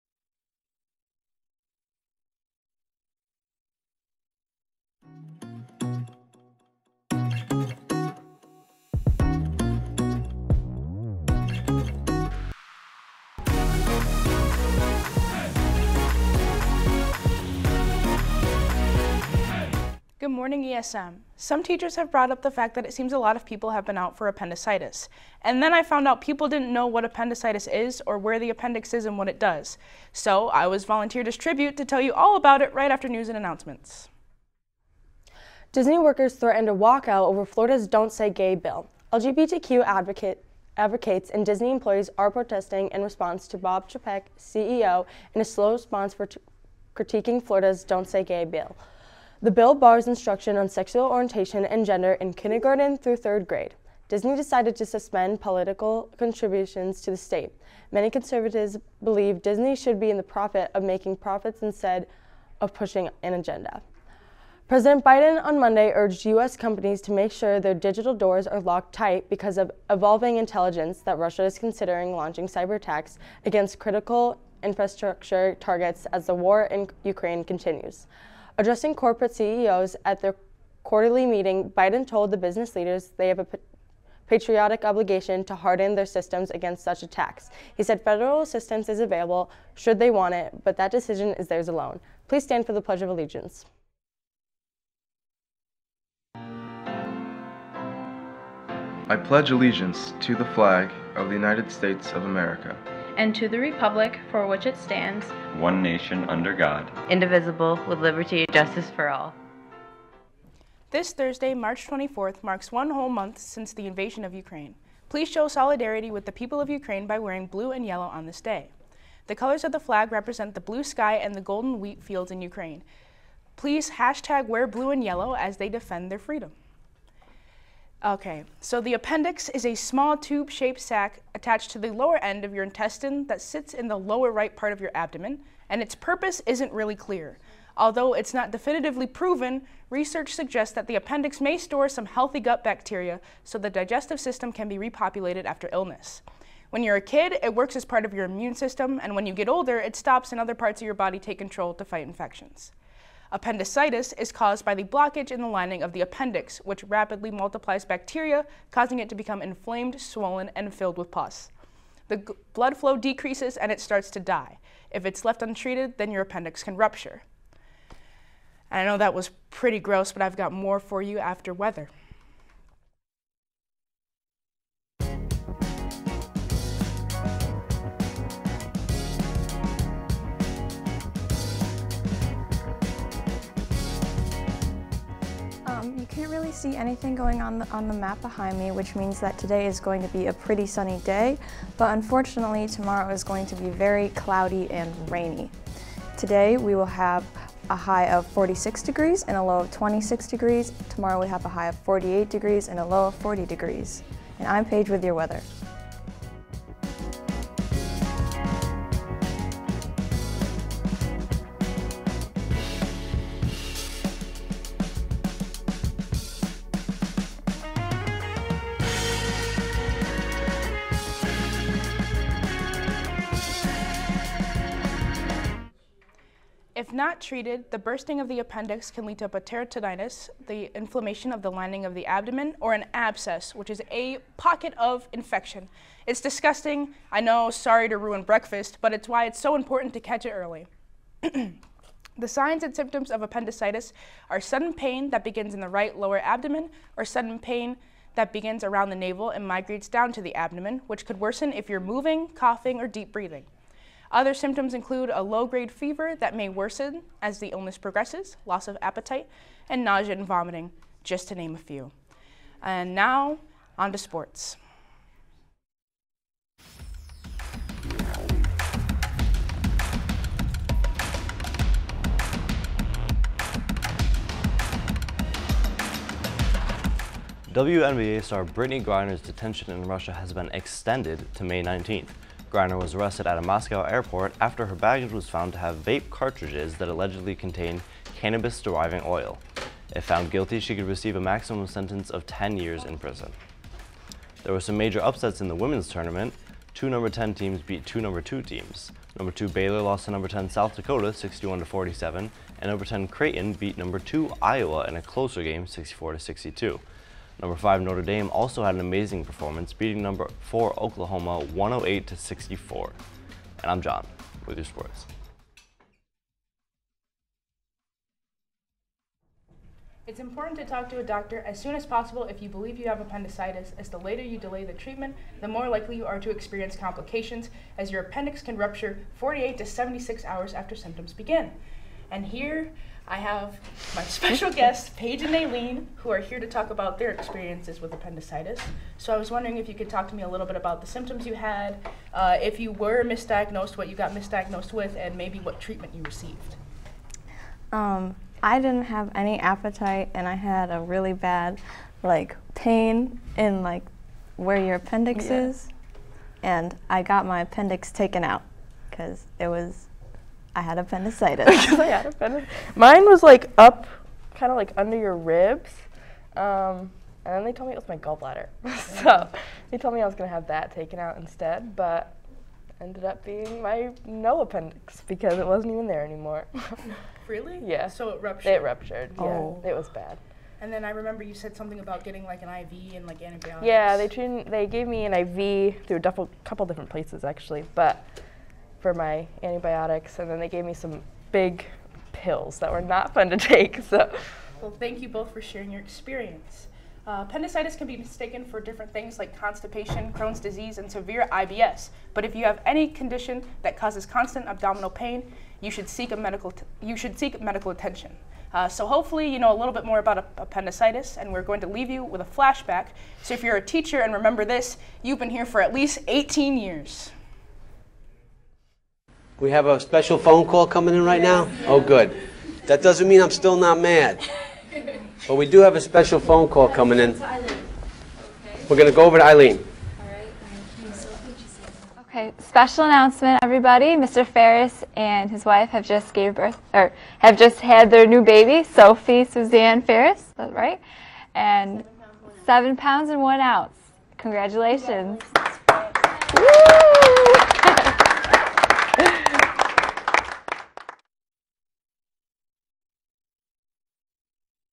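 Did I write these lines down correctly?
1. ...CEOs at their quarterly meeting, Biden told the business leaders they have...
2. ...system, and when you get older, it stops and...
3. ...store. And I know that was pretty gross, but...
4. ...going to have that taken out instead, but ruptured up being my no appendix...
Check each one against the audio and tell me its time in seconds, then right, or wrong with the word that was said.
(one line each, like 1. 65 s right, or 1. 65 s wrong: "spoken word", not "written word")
1. 79 s right
2. 148 s right
3. 166 s wrong: "rupture", not "store"
4. 370 s wrong: "ended", not "ruptured".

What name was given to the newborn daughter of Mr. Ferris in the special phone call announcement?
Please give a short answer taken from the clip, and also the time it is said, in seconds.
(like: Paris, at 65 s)
Sophie Suzanne Ferris, at 438 s.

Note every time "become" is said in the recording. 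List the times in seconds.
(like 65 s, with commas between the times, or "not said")
159 s.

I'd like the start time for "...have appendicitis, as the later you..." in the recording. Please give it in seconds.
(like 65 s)
322 s.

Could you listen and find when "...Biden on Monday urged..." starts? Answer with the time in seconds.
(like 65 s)
65 s.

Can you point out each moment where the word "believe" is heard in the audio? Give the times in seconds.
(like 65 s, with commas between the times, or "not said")
59 s, 322 s.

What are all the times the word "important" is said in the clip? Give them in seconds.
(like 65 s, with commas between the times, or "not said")
239 s, 320 s.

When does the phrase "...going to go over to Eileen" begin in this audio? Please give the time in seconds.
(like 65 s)
428 s.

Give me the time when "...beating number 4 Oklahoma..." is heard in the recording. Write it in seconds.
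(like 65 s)
309 s.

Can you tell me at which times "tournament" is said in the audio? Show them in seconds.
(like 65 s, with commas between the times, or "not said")
295 s.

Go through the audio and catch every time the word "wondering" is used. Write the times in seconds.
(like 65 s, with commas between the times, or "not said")
339 s.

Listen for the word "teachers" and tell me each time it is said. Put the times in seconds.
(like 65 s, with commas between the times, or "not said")
21 s, 413 s.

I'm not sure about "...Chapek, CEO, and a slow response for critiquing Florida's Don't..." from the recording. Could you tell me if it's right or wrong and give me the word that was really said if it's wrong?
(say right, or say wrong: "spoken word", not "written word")
right.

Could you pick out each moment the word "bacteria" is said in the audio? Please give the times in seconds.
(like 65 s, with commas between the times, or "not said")
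142 s, 157 s.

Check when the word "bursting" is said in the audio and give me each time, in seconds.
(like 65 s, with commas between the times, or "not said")
227 s.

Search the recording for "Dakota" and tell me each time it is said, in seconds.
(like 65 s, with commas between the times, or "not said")
300 s.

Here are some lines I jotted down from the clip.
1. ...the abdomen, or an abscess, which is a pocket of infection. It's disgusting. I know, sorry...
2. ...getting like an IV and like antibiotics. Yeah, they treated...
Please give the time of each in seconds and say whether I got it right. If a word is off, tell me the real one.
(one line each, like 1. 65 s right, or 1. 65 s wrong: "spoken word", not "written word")
1. 231 s right
2. 382 s right.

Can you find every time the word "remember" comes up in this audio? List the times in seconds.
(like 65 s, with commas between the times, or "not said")
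380 s, 414 s.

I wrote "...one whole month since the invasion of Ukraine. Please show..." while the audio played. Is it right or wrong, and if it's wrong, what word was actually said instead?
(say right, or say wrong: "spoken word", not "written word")
right.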